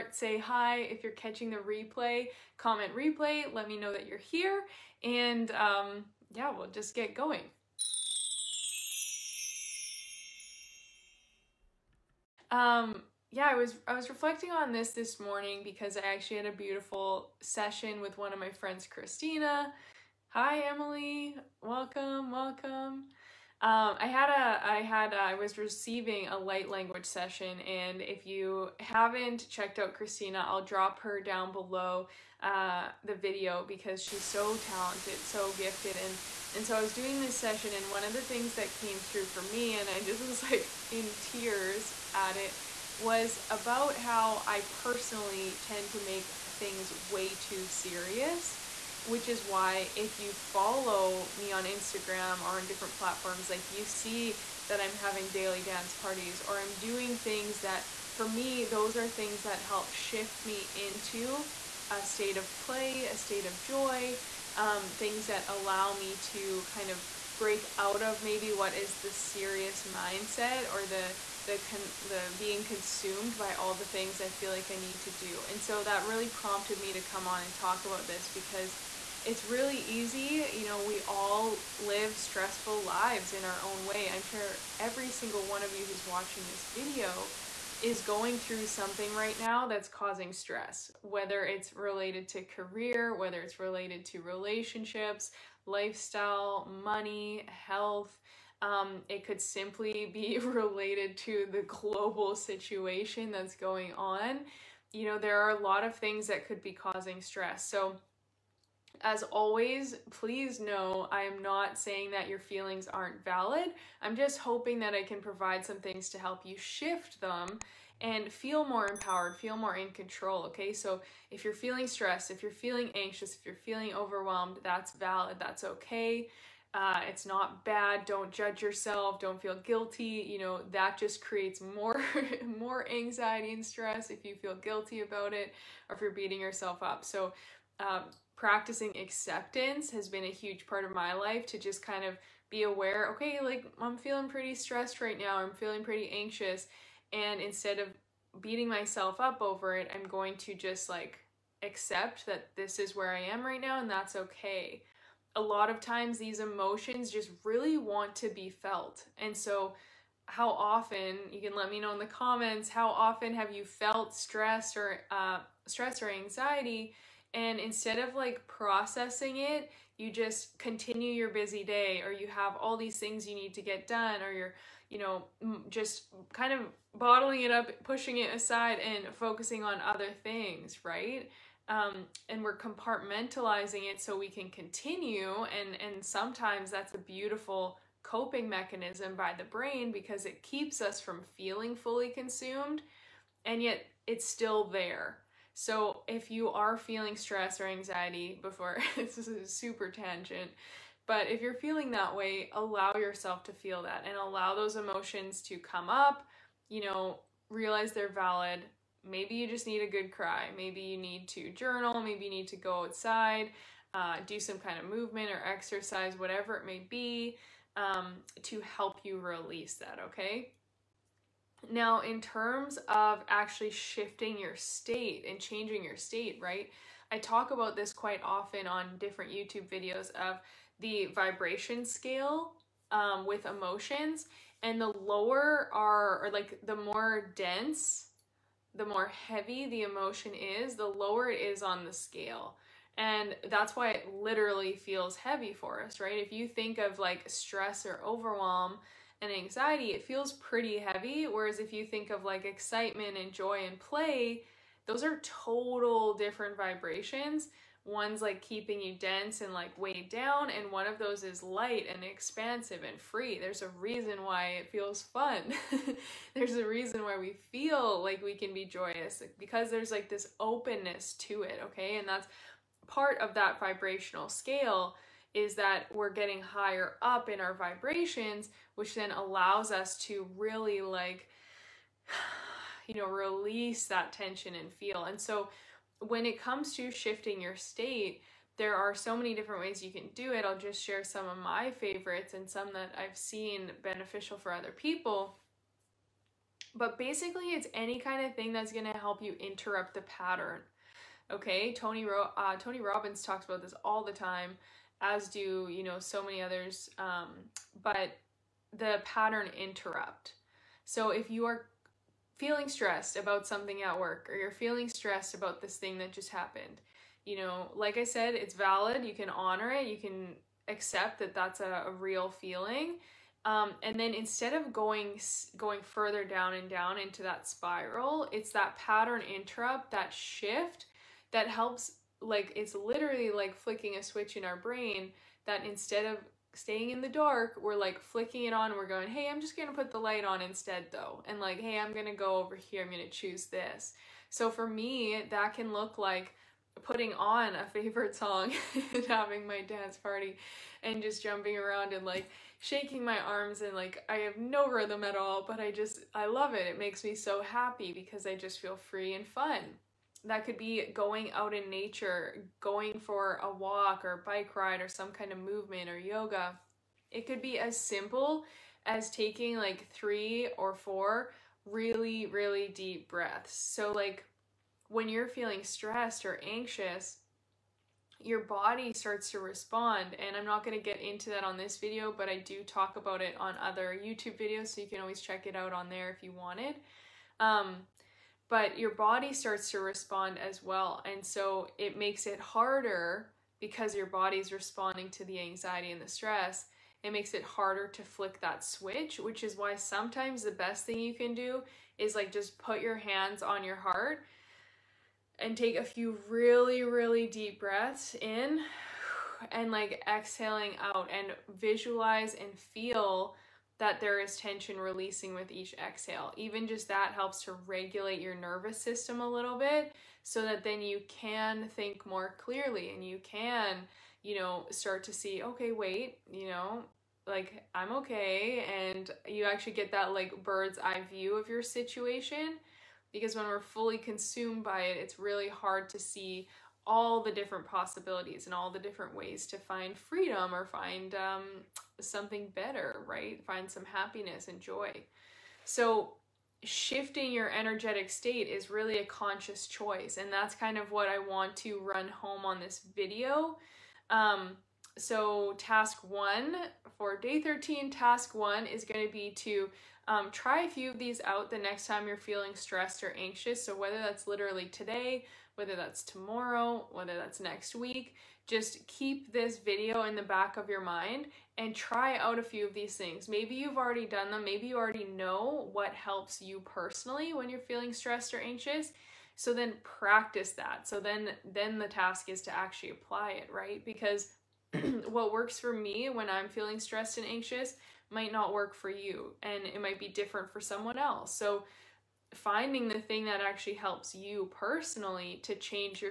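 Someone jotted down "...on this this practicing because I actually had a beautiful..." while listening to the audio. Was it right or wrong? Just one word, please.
wrong.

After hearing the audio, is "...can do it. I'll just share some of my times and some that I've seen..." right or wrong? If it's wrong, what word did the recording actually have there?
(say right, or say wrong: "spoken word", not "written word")
wrong: "favorites", not "times".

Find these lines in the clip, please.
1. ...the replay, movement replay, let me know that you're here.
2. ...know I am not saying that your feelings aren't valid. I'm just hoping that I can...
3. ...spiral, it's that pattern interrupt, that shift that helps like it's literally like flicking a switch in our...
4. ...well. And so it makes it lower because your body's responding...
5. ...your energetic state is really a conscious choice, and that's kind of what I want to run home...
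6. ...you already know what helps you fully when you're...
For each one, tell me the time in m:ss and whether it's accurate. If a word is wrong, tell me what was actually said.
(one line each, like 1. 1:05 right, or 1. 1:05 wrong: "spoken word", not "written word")
1. 0:01 wrong: "comment", not "movement"
2. 1:50 right
3. 5:27 right
4. 6:30 wrong: "harder", not "lower"
5. 7:27 right
6. 7:54 wrong: "personally", not "fully".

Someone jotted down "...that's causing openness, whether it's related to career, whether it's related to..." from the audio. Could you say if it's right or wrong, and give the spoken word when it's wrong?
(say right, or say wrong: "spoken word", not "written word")
wrong: "stress", not "openness".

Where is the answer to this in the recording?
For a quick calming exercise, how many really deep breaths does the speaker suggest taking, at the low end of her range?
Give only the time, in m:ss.
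6:09.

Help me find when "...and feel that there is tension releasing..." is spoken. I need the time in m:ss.
6:52.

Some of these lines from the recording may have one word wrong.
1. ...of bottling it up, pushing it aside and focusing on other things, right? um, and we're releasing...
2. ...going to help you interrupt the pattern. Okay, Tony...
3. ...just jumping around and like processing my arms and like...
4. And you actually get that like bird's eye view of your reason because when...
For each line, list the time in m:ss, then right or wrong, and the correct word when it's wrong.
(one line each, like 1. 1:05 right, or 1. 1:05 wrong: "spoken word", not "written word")
1. 2:56 wrong: "compartmentalizing", not "releasing"
2. 4:58 right
3. 5:51 wrong: "shaking", not "processing"
4. 7:08 wrong: "situation", not "reason".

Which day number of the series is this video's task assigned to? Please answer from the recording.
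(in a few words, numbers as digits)
13.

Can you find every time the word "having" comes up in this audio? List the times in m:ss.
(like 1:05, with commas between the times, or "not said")
0:54, 5:49.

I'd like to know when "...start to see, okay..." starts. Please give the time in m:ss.
7:04.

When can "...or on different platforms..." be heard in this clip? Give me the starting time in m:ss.
0:52.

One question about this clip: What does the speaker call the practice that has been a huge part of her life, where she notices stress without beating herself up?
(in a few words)
acceptance.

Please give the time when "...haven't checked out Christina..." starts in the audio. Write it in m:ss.
0:28.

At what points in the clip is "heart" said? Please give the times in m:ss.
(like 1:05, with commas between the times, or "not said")
6:43.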